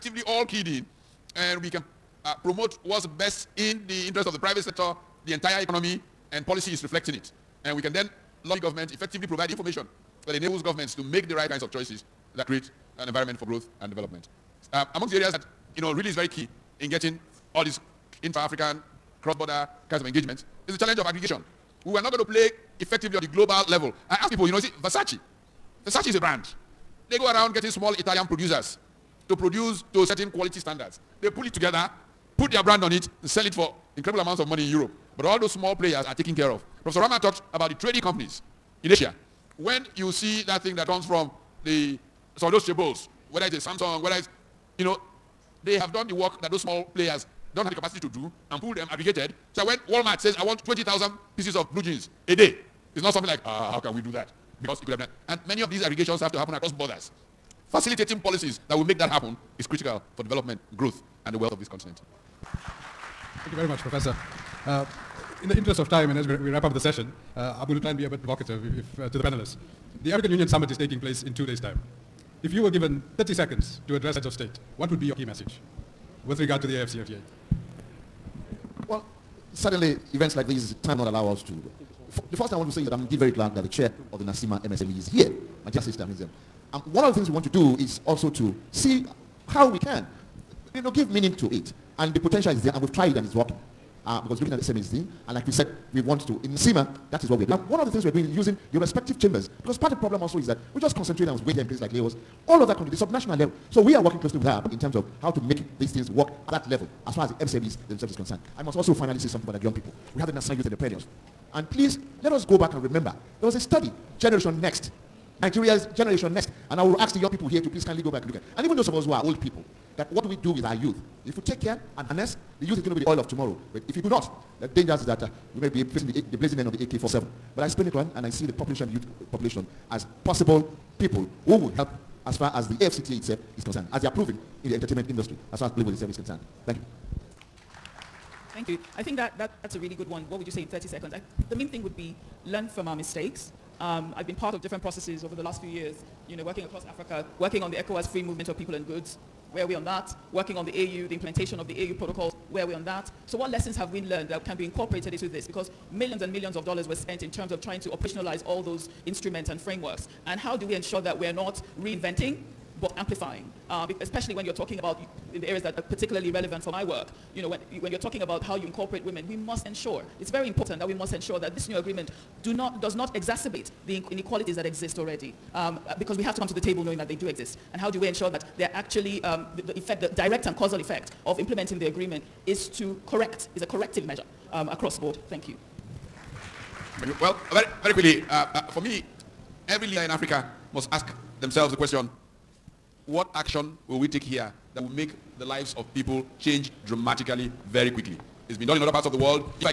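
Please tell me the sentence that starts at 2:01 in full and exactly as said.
If we take care and harness, the youth is going to be the oil of tomorrow.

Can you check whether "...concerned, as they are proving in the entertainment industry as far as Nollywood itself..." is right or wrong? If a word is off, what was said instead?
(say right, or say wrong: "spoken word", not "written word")
right.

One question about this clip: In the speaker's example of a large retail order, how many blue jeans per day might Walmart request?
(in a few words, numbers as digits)
20,000.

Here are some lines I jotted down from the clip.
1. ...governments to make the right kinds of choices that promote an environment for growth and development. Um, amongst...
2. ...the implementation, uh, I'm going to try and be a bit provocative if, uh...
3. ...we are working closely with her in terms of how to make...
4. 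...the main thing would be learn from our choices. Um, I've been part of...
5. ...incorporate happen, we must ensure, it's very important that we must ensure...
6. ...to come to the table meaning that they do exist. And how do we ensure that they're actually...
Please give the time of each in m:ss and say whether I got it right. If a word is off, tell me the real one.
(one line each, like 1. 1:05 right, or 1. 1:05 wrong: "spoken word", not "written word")
1. 0:10 wrong: "create", not "promote"
2. 1:06 wrong: "session", not "implementation"
3. 1:43 right
4. 2:21 wrong: "mistakes", not "choices"
5. 2:48 wrong: "women", not "happen"
6. 2:56 wrong: "knowing", not "meaning".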